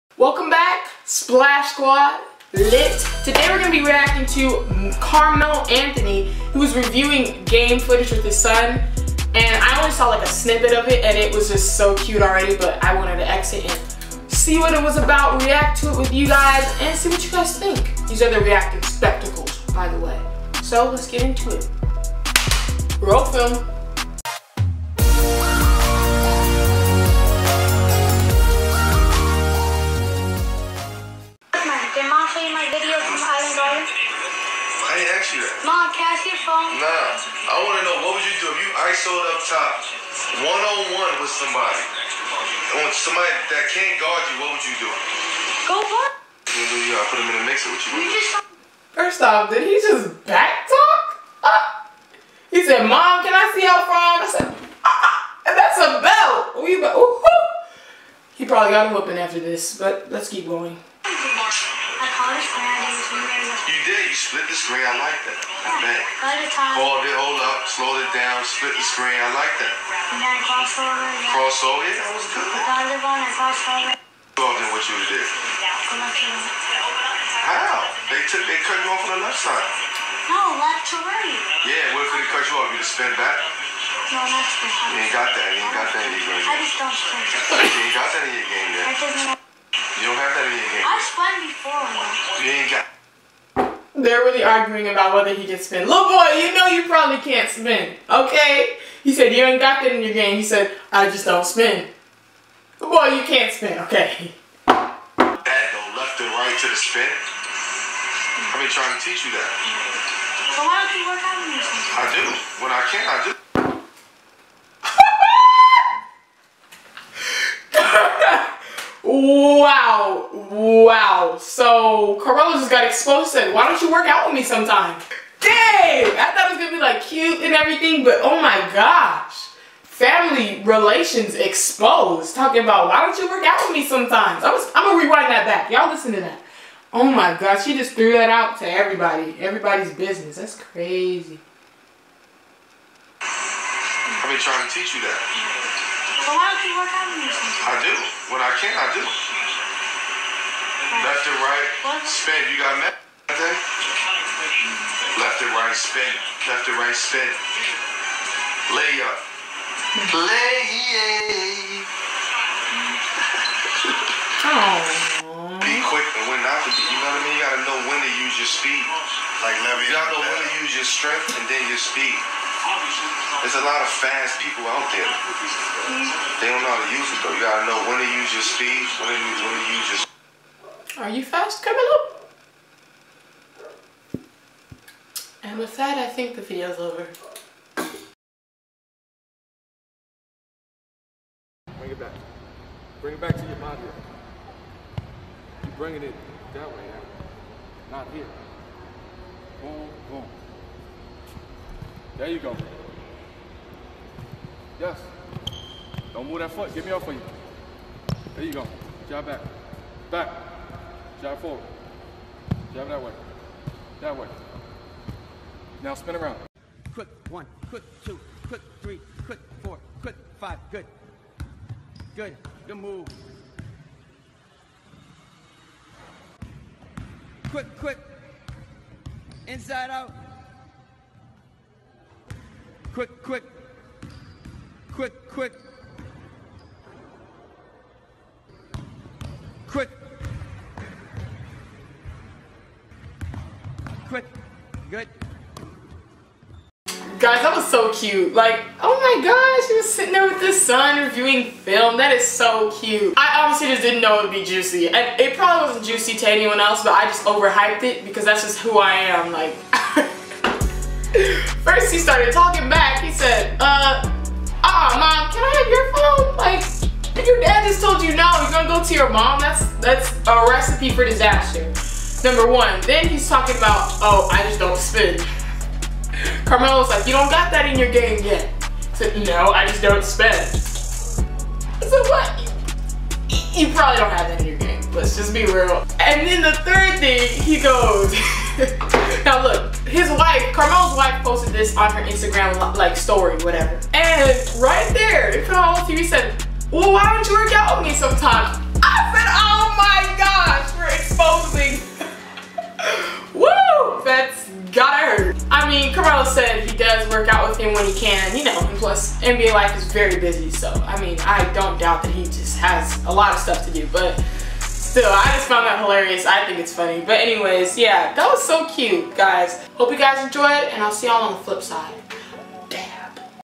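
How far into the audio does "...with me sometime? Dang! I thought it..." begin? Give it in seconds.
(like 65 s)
124 s.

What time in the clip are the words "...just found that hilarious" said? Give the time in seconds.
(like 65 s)
315 s.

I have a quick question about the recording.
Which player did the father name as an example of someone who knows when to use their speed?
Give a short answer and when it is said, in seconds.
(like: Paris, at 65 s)
Levy, at 169 s.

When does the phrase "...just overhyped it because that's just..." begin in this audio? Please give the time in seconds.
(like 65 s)
257 s.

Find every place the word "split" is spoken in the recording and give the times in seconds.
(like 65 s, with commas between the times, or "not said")
64 s, 68 s.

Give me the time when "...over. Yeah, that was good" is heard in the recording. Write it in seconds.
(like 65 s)
71 s.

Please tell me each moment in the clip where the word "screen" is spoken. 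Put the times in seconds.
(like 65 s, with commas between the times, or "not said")
64 s, 68 s.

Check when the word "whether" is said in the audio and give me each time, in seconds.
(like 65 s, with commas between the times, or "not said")
95 s.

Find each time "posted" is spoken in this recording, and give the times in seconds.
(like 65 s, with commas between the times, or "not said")
291 s.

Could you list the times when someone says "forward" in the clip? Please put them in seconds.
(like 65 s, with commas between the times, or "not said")
211 s.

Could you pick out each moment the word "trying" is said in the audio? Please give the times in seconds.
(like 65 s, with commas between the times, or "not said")
108 s, 144 s.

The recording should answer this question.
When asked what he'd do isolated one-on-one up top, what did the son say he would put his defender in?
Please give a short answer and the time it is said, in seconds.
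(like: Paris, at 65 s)
A mixer, at 47 s.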